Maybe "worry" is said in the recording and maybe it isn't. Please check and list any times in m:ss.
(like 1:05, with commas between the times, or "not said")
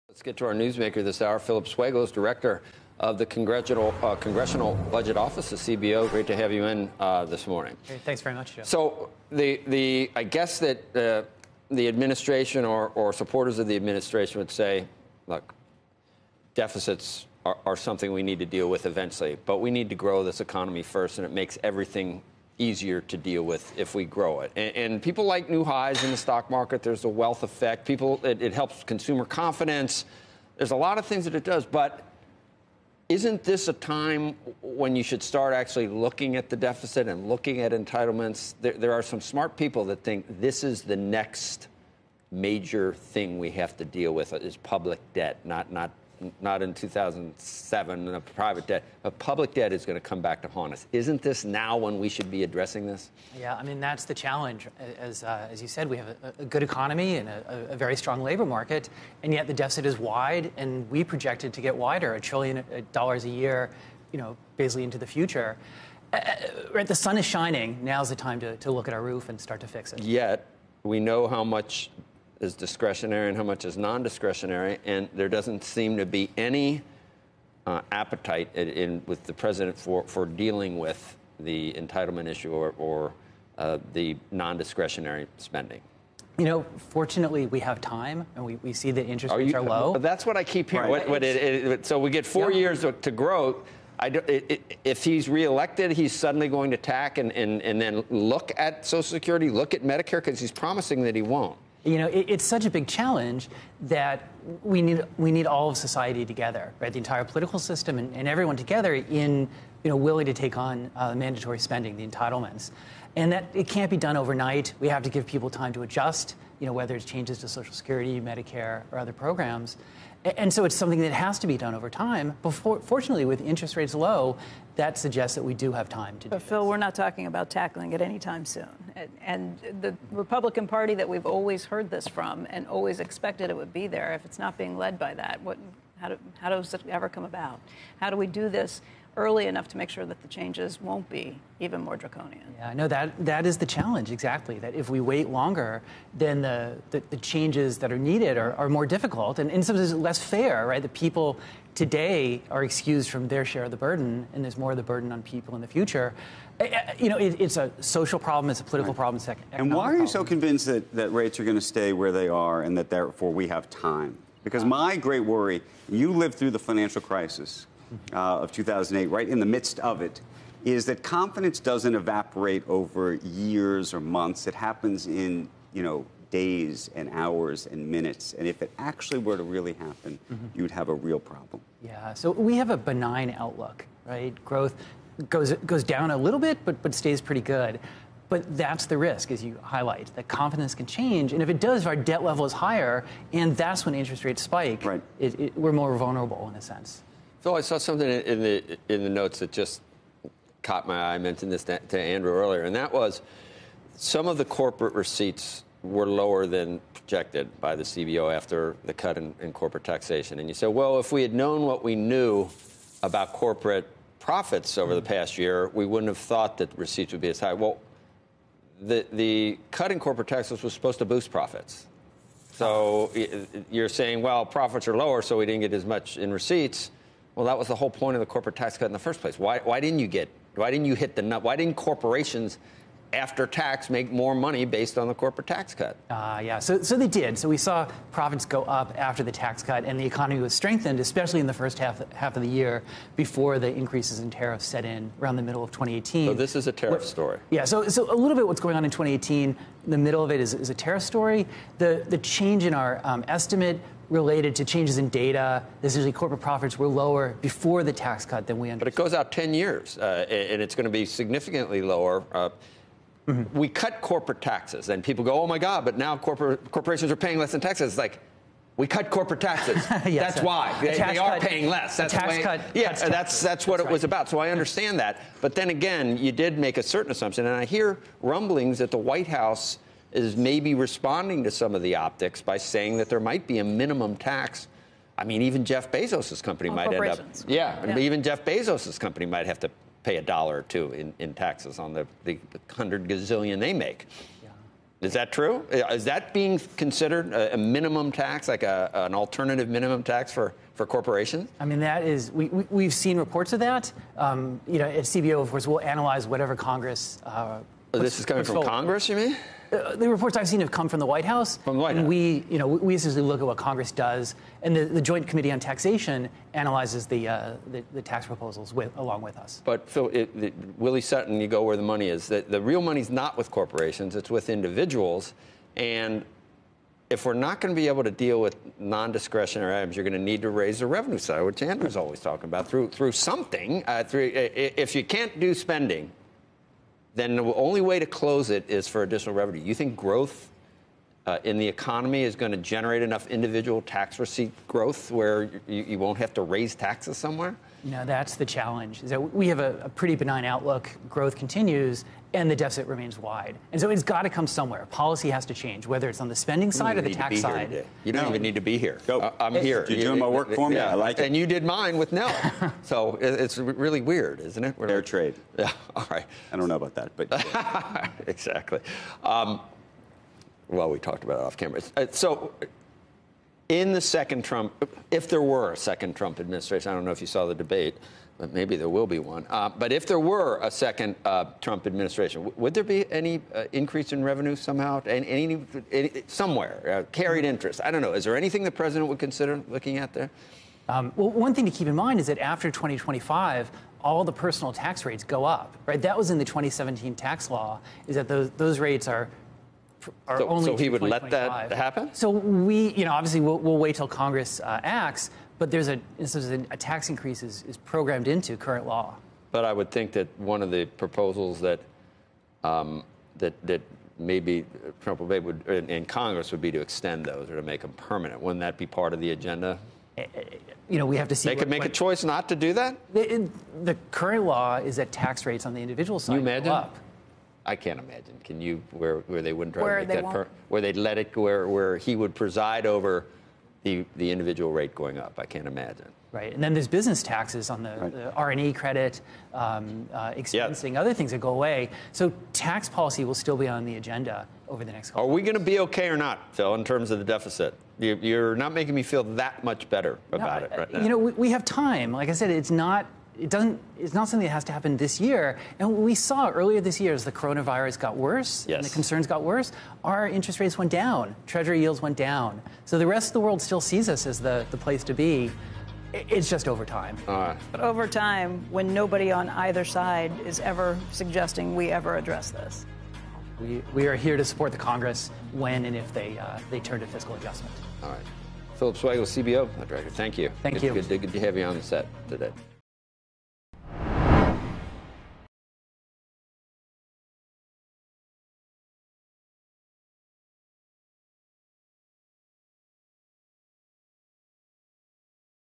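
2:45.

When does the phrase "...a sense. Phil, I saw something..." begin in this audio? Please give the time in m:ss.
3:16.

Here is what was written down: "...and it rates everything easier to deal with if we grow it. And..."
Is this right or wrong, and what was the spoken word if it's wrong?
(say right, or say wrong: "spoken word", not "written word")
wrong: "makes", not "rates".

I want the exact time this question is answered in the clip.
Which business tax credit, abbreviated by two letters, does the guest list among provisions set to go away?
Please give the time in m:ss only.
7:18.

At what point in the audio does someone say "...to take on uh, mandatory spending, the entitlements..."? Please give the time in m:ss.
1:50.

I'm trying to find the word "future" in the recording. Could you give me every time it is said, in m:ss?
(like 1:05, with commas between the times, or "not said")
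1:05, 2:35.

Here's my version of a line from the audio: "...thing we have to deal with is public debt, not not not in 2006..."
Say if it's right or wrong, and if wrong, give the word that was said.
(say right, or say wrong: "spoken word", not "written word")
wrong: "2007", not "2006".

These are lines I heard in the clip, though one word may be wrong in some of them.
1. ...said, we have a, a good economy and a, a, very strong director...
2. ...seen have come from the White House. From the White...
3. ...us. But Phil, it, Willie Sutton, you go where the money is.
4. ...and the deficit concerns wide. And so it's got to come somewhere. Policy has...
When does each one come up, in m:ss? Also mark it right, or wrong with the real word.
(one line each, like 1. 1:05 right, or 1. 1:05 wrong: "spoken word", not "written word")
1. 0:55 wrong: "labor", not "director"
2. 5:10 right
3. 5:19 right
4. 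5:52 wrong: "remains", not "concerns".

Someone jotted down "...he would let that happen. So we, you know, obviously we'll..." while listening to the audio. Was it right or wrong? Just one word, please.
right.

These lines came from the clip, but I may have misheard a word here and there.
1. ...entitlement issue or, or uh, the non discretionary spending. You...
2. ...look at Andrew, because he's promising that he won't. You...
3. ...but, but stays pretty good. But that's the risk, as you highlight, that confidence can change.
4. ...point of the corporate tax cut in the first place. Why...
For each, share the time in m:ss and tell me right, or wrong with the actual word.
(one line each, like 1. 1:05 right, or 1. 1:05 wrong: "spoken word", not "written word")
1. 1:21 right
2. 1:39 wrong: "Medicare", not "Andrew"
3. 3:06 right
4. 3:47 right.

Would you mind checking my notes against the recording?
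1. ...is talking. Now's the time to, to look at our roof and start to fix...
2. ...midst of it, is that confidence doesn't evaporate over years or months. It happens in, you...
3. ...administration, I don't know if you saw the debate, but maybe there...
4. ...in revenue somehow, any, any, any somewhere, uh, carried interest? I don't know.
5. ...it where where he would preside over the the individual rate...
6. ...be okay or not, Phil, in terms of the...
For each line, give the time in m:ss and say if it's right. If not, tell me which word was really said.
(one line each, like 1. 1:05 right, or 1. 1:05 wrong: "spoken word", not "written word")
1. 1:07 wrong: "shining", not "talking"
2. 2:49 right
3. 6:16 right
4. 6:24 right
5. 7:11 right
6. 7:25 right.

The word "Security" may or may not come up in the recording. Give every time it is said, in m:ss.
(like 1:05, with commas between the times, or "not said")
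1:39, 1:57.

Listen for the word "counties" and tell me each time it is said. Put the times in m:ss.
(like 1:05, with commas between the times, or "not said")
not said.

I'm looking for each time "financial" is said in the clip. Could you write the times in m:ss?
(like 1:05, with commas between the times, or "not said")
2:46.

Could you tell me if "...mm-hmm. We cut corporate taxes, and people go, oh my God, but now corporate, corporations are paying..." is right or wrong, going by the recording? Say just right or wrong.
right.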